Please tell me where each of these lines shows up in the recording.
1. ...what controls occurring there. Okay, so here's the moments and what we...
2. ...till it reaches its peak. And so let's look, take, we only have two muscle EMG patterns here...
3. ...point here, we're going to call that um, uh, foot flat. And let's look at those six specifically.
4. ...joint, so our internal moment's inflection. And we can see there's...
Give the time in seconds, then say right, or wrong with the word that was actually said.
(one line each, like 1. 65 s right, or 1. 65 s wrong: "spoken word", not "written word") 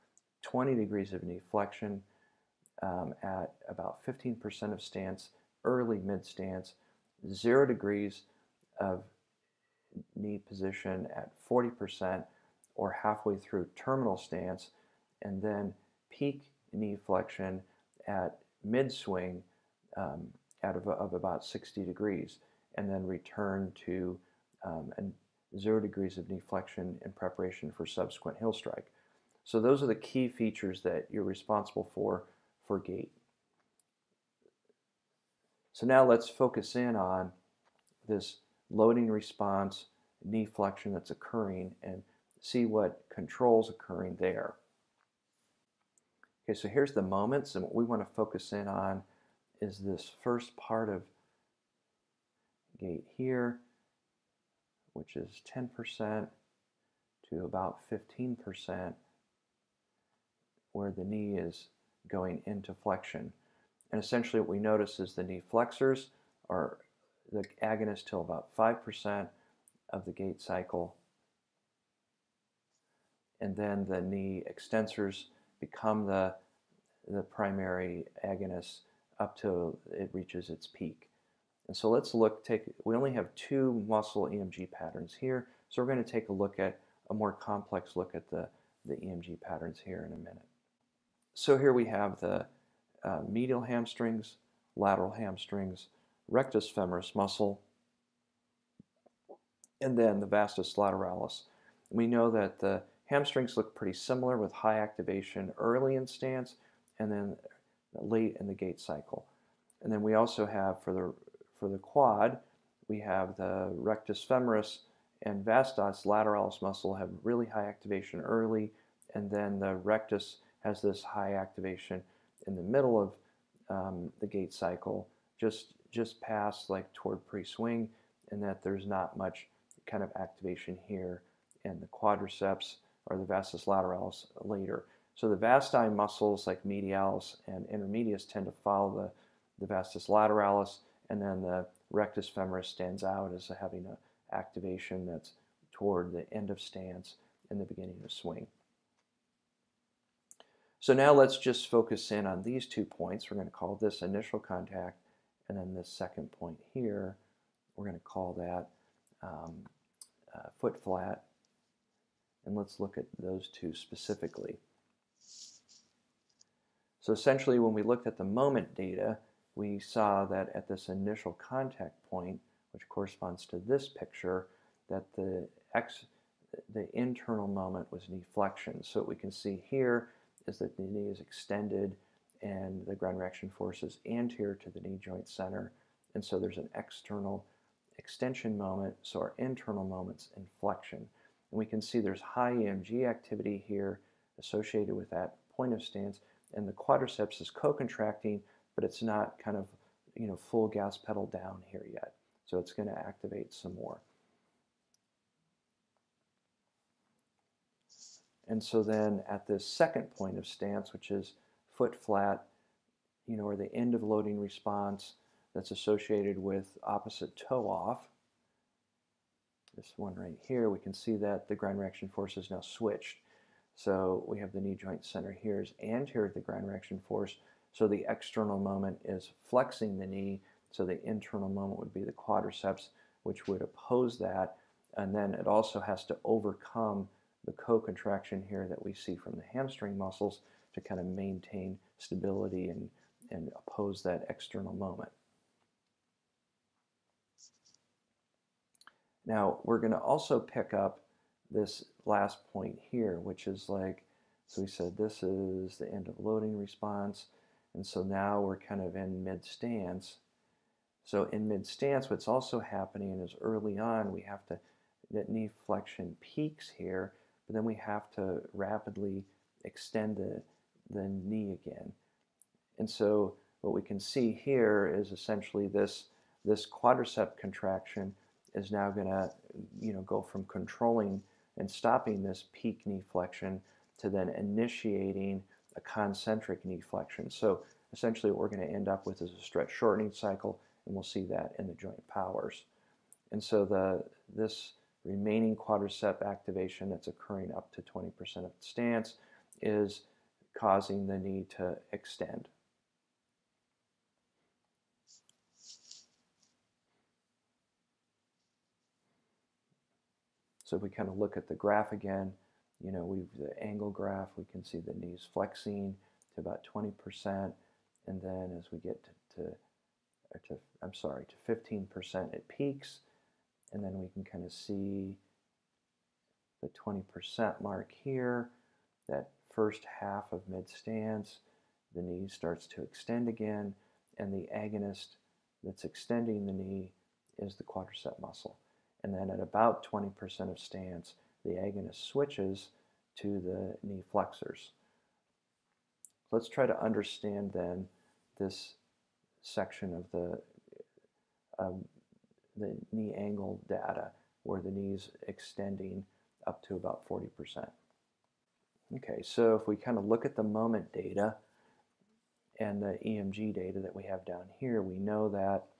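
1. 42 s right
2. 79 s right
3. 156 s wrong: "two", not "six"
4. 188 s wrong: "moment", not "joint".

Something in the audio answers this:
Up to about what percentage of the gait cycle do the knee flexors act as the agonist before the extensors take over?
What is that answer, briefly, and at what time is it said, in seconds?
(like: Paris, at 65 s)
5%, at 68 s.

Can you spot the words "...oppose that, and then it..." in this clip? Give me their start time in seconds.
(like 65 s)
233 s.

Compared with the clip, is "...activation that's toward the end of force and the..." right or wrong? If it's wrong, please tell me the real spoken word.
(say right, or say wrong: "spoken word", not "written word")
wrong: "stance", not "force".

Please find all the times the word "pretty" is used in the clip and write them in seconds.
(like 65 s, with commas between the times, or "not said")
103 s.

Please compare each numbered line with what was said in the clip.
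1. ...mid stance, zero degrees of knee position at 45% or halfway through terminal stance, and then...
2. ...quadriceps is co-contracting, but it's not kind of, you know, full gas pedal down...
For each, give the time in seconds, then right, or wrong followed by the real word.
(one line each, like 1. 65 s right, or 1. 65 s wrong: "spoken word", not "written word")
1. 5 s wrong: "40", not "45"
2. 196 s right.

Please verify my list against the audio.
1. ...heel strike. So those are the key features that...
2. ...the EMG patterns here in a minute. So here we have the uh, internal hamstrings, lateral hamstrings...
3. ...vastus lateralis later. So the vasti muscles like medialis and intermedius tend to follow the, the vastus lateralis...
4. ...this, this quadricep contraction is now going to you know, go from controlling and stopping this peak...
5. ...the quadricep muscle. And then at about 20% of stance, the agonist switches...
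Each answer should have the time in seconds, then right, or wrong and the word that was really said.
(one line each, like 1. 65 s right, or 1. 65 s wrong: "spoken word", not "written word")
1. 28 s right
2. 88 s wrong: "medial", not "internal"
3. 133 s right
4. 275 s right
5. 337 s right.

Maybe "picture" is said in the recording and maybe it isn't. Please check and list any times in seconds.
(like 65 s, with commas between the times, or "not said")
173 s.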